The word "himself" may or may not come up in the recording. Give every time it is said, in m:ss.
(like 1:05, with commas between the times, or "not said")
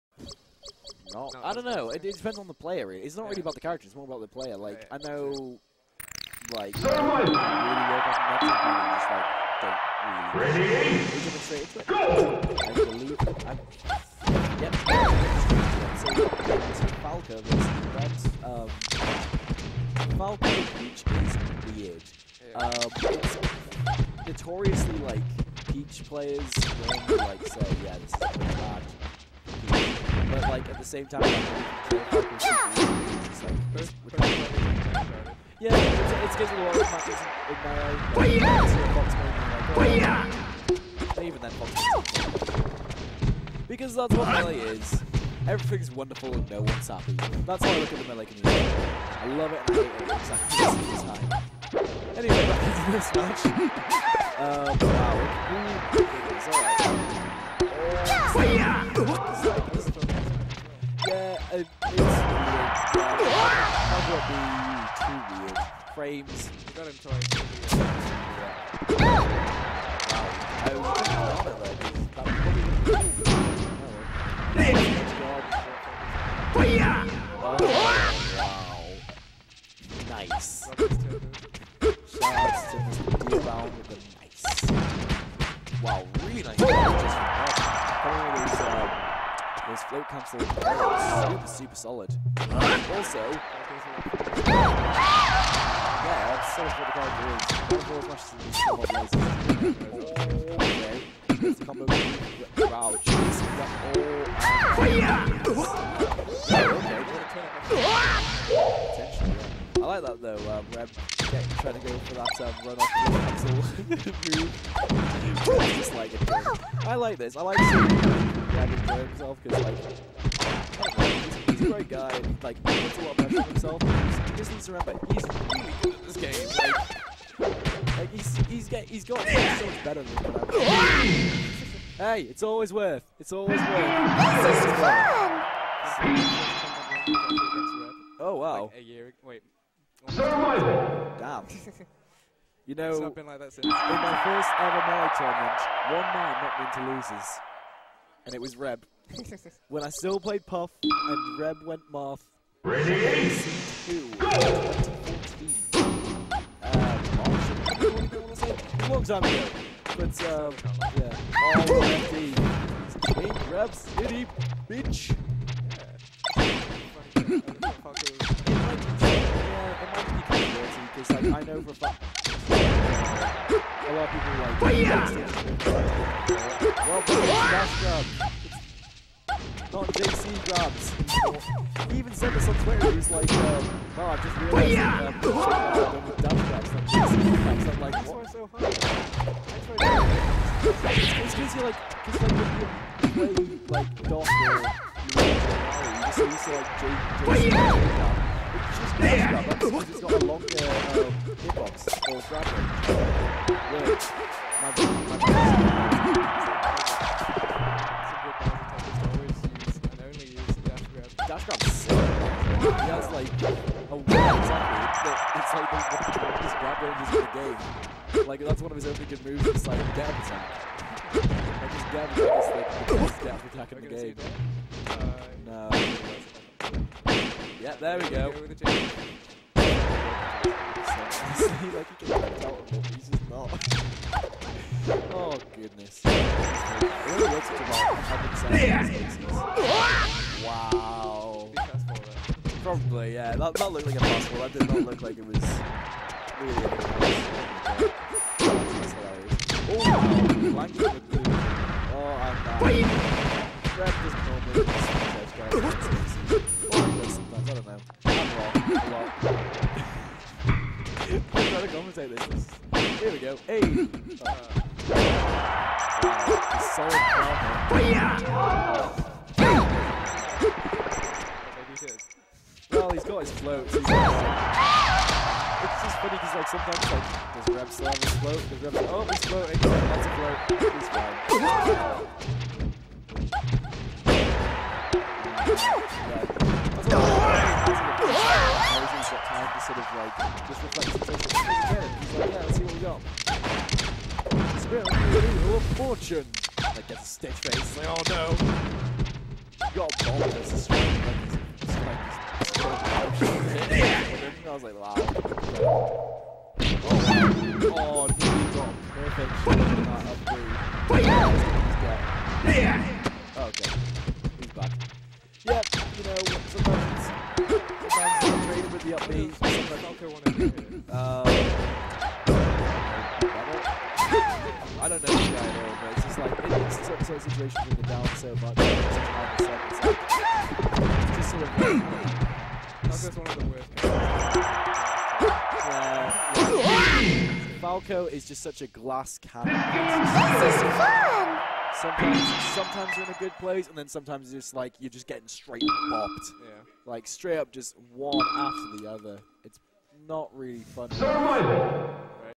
1:58, 2:03.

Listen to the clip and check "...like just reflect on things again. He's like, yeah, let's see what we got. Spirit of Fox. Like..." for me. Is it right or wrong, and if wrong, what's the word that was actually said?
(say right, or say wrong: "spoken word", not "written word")
wrong: "Fortune", not "Fox".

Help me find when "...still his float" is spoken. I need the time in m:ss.
4:37.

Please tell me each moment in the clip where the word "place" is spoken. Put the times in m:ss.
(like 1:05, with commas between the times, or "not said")
5:43.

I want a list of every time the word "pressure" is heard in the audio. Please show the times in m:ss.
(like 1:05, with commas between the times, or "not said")
2:03.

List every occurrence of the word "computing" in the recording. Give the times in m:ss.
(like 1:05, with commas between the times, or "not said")
not said.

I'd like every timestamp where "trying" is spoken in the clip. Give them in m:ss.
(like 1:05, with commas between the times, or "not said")
4:21.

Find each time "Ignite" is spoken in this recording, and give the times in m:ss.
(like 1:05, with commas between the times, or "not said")
0:36.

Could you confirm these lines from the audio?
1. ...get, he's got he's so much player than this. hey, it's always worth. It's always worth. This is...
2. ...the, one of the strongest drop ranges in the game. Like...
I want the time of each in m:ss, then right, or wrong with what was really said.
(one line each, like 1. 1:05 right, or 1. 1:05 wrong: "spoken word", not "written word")
1. 2:08 wrong: "better", not "player"
2. 3:35 right.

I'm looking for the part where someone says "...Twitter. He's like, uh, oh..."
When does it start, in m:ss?
3:02.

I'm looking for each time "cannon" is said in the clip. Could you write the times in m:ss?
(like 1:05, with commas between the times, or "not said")
5:39.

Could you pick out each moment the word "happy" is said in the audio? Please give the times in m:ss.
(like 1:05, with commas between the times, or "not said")
0:46.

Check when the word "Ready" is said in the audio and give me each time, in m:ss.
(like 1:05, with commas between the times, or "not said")
0:10, 2:32.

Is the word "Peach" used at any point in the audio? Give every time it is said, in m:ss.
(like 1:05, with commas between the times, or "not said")
0:20, 0:25.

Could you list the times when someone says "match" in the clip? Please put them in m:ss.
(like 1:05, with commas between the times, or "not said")
0:53.